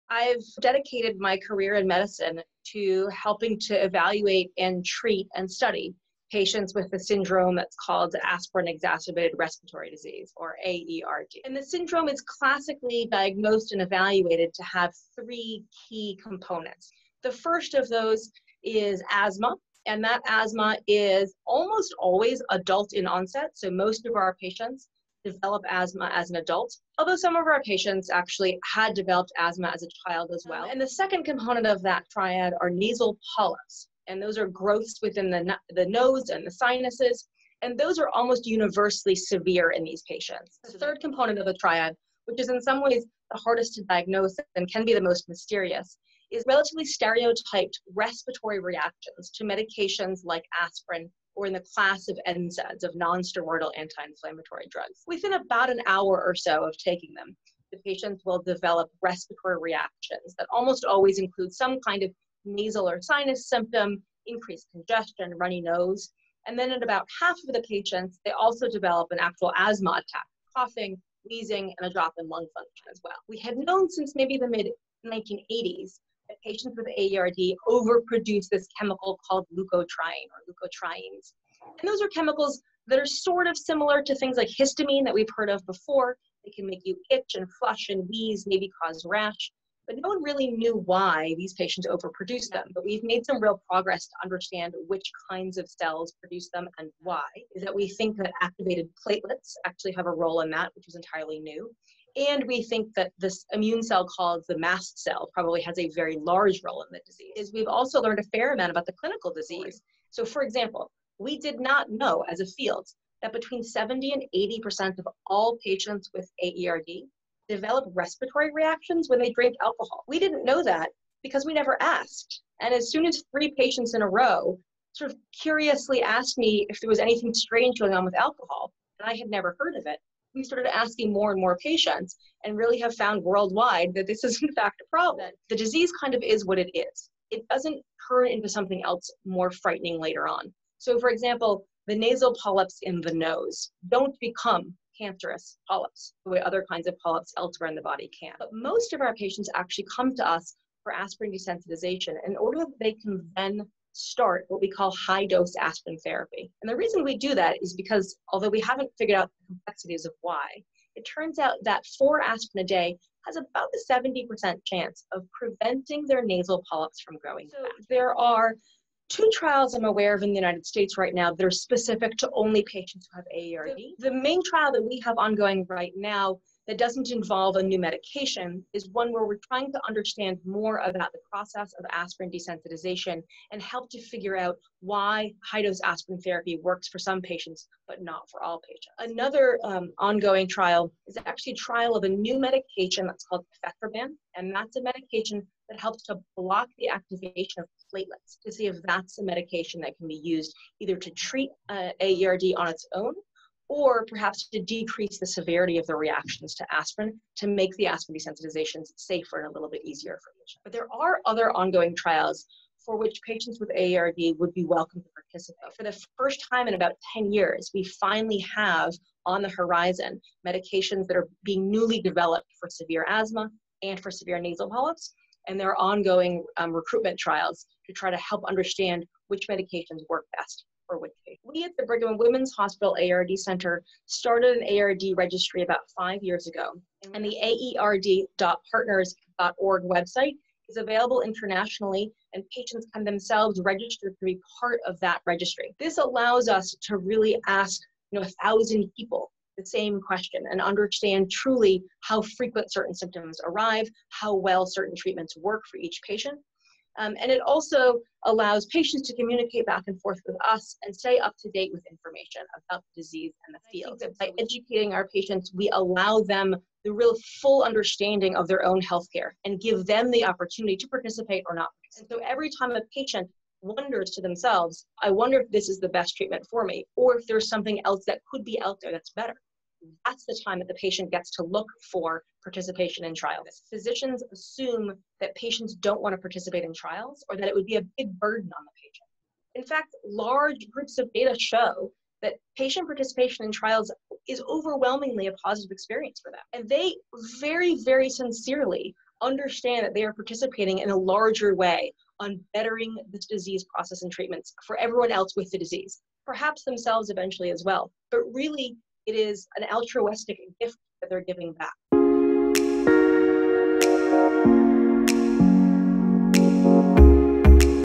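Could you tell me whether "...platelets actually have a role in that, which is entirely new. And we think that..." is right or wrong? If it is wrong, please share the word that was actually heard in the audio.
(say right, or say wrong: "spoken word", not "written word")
right.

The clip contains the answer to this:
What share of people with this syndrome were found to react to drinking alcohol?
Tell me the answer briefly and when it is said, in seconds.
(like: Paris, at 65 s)
70 to 80%, at 113 s.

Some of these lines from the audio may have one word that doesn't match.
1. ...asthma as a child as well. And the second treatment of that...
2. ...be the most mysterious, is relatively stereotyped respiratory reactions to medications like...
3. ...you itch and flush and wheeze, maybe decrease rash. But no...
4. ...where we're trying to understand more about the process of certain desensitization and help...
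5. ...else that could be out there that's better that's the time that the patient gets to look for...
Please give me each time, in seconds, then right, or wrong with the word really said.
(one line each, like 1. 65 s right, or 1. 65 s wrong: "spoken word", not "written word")
1. 29 s wrong: "component", not "treatment"
2. 44 s right
3. 86 s wrong: "cause", not "decrease"
4. 179 s wrong: "aspirin", not "certain"
5. 277 s right.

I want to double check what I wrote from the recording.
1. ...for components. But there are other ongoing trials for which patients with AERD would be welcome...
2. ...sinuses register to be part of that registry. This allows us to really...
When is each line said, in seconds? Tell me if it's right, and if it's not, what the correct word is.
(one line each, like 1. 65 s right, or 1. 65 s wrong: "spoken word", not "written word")
1. 210 s wrong: "patients", not "components"
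2. 243 s wrong: "themselves", not "sinuses".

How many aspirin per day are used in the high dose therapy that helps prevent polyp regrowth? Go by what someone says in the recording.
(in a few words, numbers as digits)
4.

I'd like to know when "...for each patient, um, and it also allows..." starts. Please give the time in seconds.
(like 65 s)
255 s.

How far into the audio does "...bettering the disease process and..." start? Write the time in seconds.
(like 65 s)
302 s.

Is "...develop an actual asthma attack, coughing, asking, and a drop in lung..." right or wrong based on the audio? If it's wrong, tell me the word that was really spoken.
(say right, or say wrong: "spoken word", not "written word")
wrong: "wheezing", not "asking".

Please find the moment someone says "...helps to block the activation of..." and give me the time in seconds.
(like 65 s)
195 s.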